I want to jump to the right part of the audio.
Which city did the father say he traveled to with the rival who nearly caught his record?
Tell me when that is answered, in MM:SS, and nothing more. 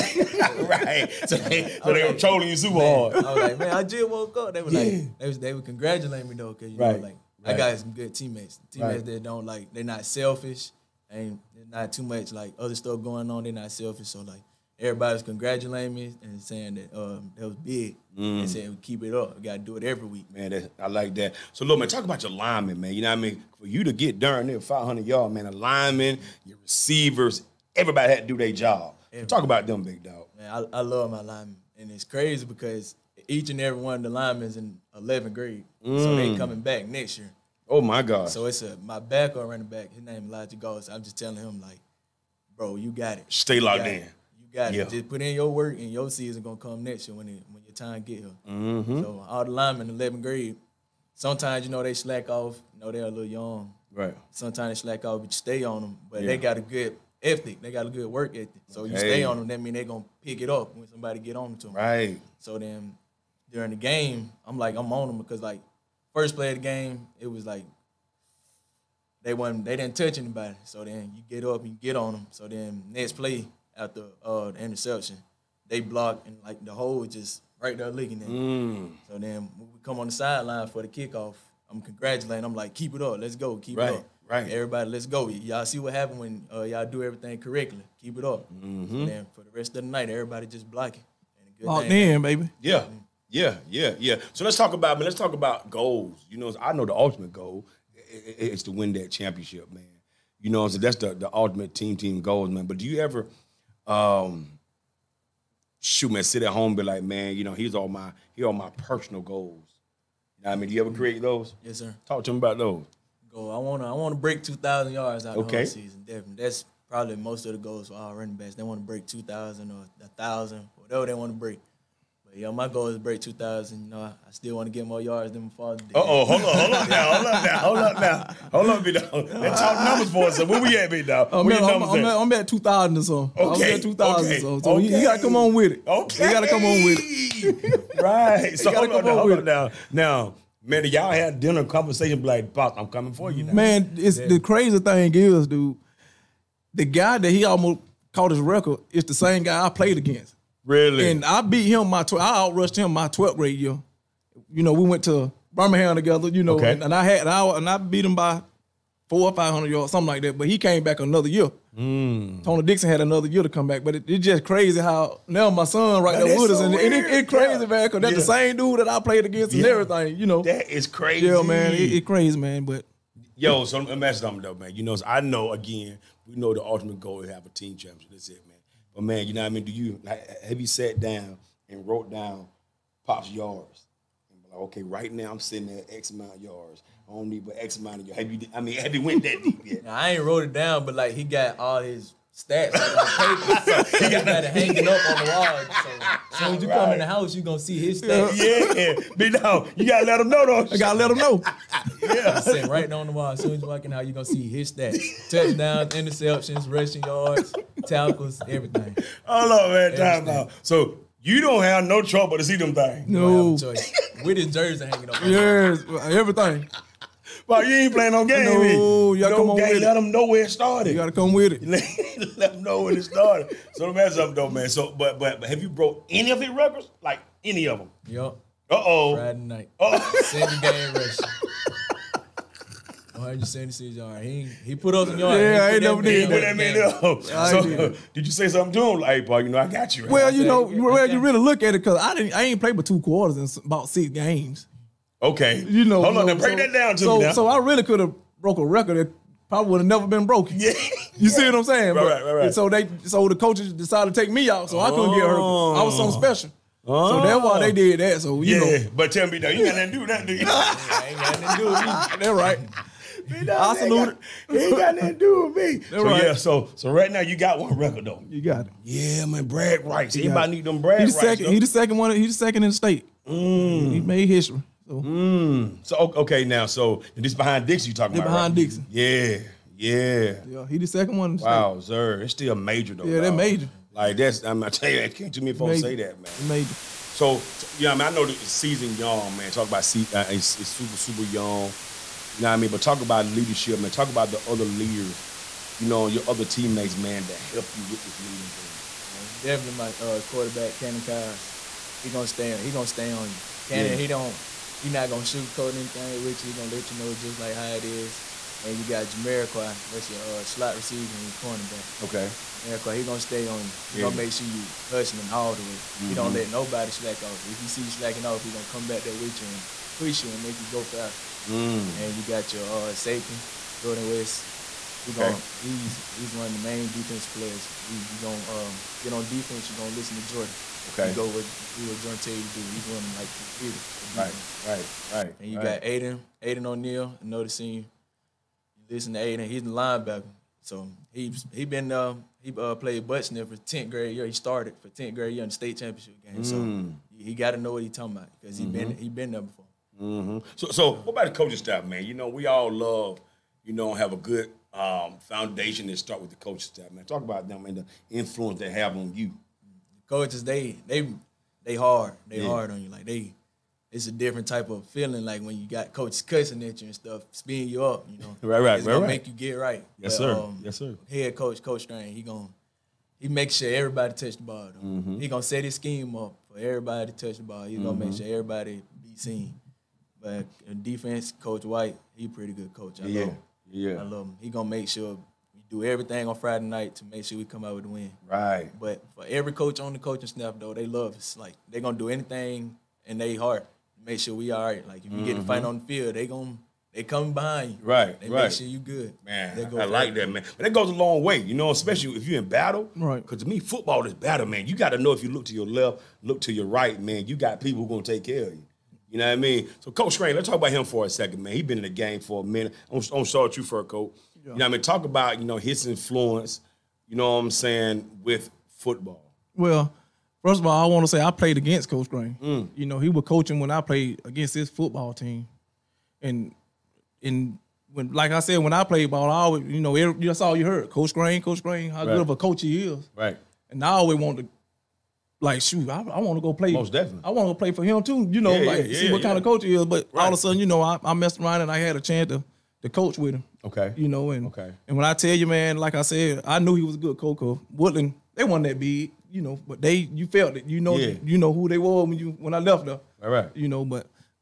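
02:35.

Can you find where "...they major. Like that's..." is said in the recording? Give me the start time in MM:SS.
04:43.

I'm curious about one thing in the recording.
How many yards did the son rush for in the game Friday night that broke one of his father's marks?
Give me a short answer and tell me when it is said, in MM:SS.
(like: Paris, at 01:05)
176, at 03:53.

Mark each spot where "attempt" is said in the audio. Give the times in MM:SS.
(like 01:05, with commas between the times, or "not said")
not said.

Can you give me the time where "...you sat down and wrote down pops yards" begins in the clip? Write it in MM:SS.
03:00.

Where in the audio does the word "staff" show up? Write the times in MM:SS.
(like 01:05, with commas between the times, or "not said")
05:51, 05:56, 06:30.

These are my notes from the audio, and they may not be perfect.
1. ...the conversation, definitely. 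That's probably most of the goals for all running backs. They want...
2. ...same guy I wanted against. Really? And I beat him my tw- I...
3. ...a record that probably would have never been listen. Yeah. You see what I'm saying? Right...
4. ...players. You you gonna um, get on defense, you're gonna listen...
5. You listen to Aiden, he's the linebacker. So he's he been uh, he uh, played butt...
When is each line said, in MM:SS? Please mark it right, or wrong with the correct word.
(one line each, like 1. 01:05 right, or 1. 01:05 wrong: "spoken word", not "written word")
1. 01:55 wrong: "season", not "conversation"
2. 02:29 wrong: "played", not "wanted"
3. 04:08 wrong: "broken", not "listen"
4. 05:27 right
5. 05:38 right.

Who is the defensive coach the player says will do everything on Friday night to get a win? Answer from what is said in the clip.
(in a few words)
Coach White.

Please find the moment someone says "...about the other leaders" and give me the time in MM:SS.
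04:54.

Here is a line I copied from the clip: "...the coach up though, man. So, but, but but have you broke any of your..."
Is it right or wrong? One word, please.
wrong.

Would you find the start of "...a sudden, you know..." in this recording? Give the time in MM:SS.
07:20.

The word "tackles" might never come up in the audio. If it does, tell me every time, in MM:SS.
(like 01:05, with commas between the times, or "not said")
03:27.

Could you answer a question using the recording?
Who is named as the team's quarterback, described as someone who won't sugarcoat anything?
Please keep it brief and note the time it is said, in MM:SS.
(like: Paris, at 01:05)
Cannon Kyles, at 05:00.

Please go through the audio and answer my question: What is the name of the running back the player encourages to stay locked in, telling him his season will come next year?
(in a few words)
Elijah Goss.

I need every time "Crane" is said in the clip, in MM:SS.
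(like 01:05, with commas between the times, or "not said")
06:50.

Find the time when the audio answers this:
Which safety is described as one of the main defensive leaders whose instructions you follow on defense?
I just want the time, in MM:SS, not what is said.
05:23.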